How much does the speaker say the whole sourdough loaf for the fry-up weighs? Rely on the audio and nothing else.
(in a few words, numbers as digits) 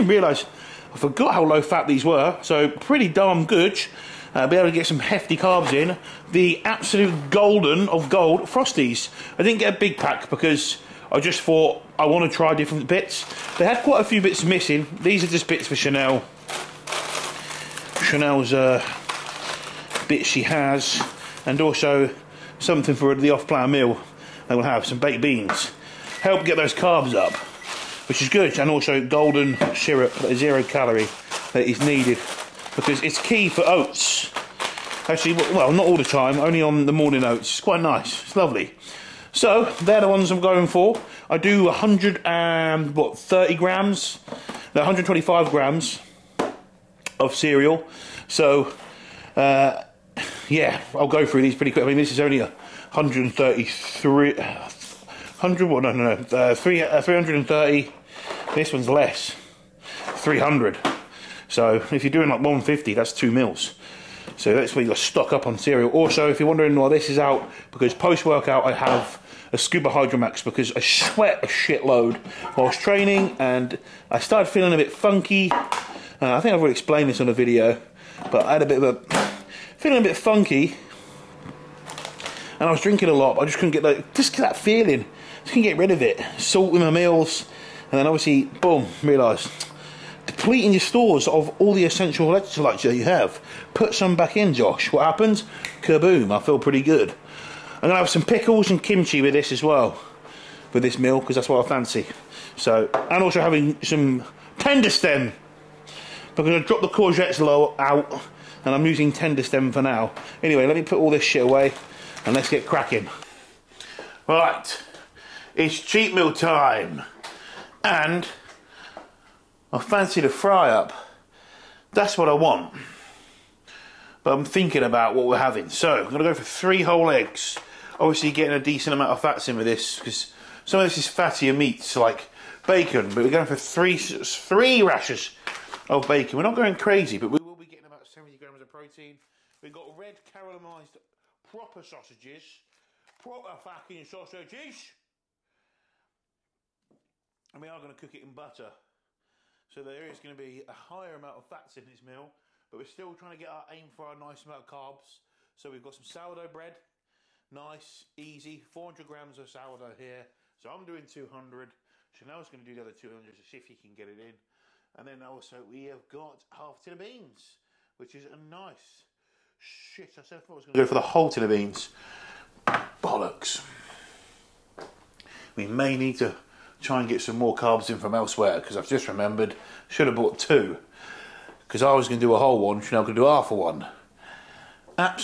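400 grams.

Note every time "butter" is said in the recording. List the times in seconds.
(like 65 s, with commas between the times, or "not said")
148 s.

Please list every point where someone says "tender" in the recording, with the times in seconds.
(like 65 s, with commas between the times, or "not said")
104 s, 109 s.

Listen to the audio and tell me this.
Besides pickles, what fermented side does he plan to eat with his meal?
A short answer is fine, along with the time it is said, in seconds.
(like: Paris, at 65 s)
Kimchi, at 98 s.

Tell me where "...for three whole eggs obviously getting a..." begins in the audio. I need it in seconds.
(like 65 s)
126 s.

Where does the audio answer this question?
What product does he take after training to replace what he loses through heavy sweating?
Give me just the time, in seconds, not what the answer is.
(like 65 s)
69 s.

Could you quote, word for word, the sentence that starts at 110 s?
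Anyway, let me put all this shit away, and let's get cracking.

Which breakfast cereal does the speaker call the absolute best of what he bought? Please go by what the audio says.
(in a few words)
Frosties.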